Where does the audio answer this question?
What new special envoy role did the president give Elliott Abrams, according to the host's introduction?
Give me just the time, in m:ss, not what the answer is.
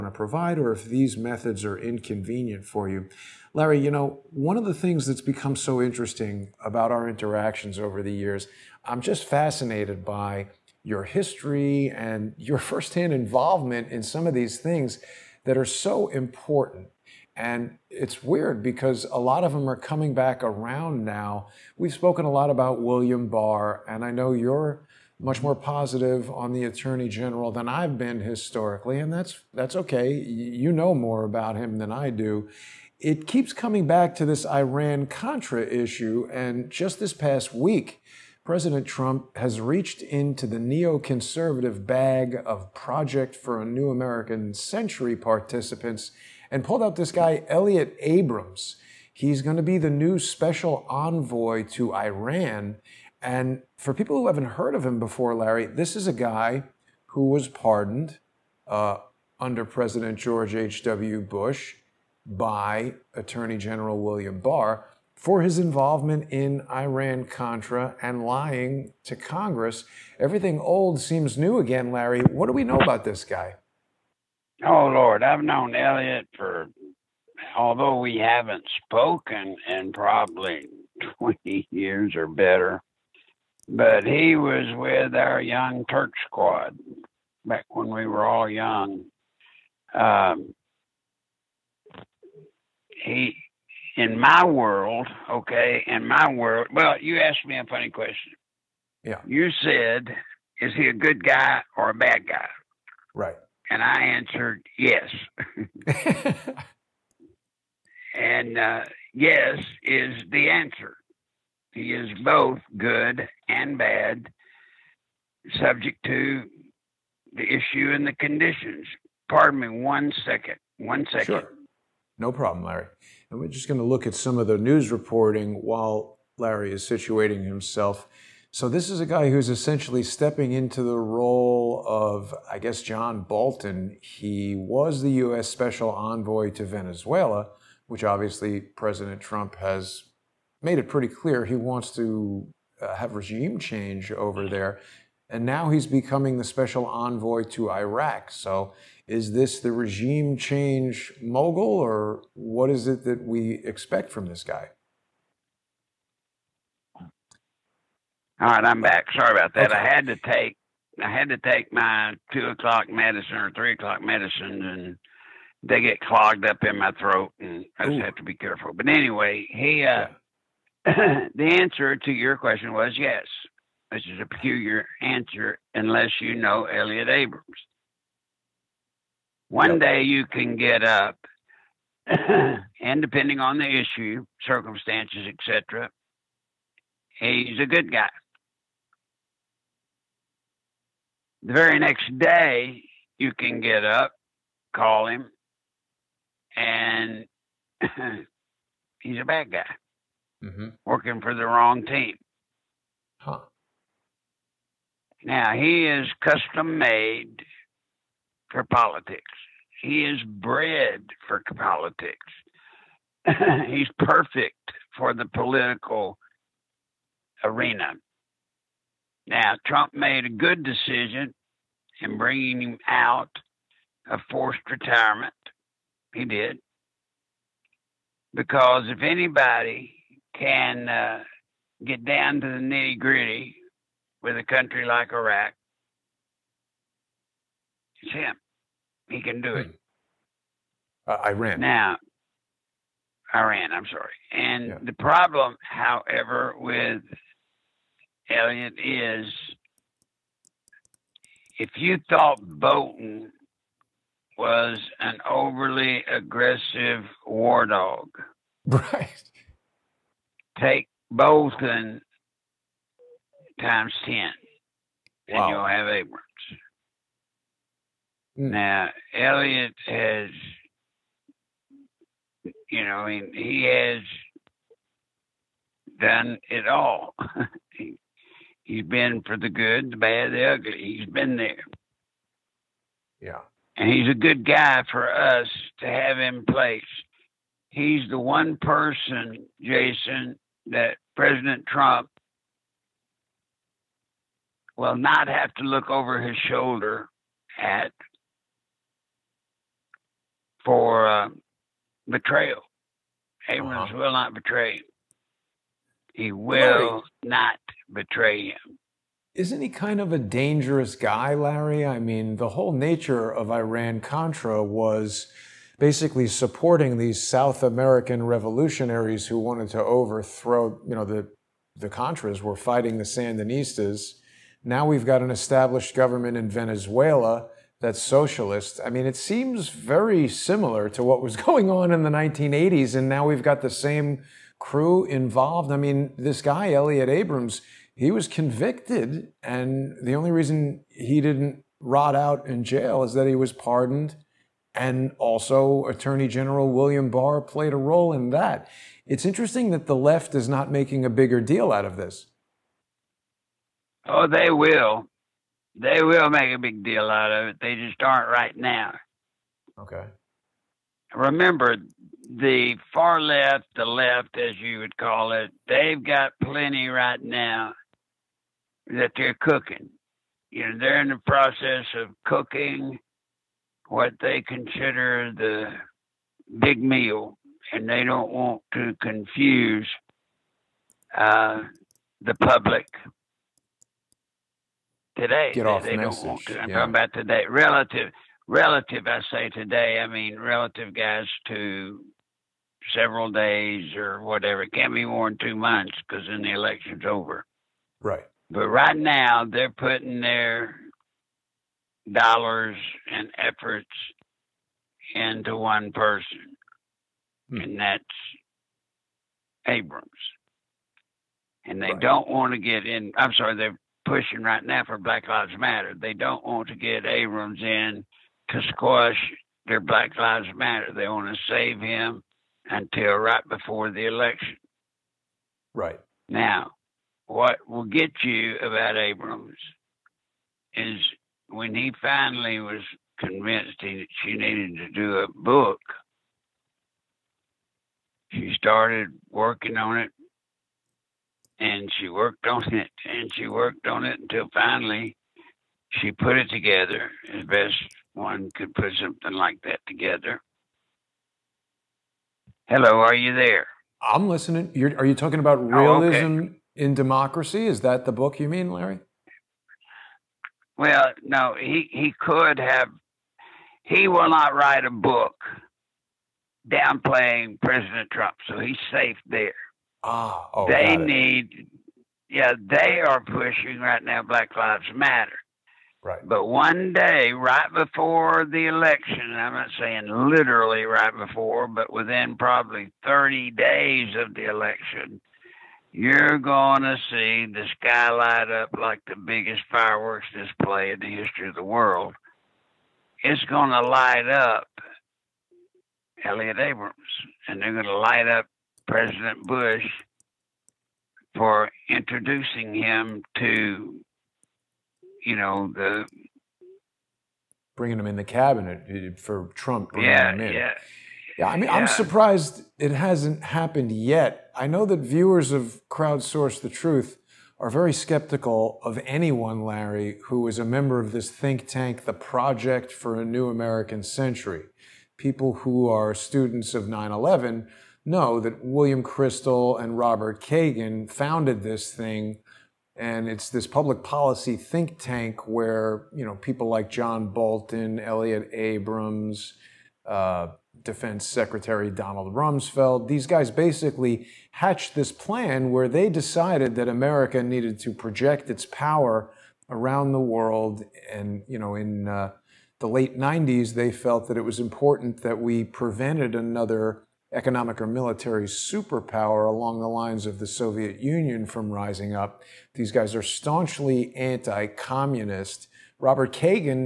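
0:50.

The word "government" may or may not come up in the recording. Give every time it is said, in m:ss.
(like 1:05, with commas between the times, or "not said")
5:25.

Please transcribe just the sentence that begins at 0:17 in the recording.
And it's weird because a lot of them are coming back around now.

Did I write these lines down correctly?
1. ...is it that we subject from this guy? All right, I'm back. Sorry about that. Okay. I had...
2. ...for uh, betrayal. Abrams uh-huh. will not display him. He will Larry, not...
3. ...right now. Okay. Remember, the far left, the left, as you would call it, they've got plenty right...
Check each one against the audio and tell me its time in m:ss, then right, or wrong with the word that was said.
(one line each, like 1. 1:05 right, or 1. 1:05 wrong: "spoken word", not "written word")
1. 2:32 wrong: "expect", not "subject"
2. 5:00 wrong: "betray", not "display"
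3. 5:58 right.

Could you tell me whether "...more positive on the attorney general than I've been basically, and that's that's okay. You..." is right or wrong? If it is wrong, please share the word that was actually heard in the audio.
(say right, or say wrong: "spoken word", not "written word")
wrong: "historically", not "basically".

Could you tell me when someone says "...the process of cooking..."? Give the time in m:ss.
6:11.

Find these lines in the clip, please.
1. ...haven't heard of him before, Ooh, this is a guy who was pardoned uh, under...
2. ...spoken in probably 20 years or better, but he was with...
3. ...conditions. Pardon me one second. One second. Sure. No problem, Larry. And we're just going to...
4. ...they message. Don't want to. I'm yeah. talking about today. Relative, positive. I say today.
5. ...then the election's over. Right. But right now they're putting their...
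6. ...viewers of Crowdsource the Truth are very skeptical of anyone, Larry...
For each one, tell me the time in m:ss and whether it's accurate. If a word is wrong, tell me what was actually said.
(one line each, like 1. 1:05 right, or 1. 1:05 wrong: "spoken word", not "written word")
1. 0:54 wrong: "Larry", not "Ooh"
2. 1:18 right
3. 1:58 right
4. 6:25 wrong: "relative", not "positive"
5. 6:36 right
6. 8:34 right.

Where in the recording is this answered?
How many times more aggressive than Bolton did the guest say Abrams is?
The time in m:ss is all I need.
4:20.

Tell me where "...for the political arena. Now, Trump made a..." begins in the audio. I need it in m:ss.
3:34.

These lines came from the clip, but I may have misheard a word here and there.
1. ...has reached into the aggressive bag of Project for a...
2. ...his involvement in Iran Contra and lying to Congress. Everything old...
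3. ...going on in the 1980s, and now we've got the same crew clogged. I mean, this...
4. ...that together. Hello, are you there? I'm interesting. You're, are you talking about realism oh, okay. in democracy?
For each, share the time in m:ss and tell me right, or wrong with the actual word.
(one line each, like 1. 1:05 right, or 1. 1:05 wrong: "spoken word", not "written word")
1. 0:39 wrong: "neoconservative", not "aggressive"
2. 1:05 right
3. 5:31 wrong: "involved", not "clogged"
4. 7:29 wrong: "listening", not "interesting".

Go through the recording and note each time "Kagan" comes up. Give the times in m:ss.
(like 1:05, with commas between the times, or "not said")
8:50, 9:26.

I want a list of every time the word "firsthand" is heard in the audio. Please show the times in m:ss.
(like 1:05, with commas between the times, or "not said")
0:12.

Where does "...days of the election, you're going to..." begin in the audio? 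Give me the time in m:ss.
8:03.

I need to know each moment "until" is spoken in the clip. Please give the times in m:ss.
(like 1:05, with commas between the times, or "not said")
7:02, 7:24.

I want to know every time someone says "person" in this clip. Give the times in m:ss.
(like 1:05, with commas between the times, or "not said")
4:48, 6:45.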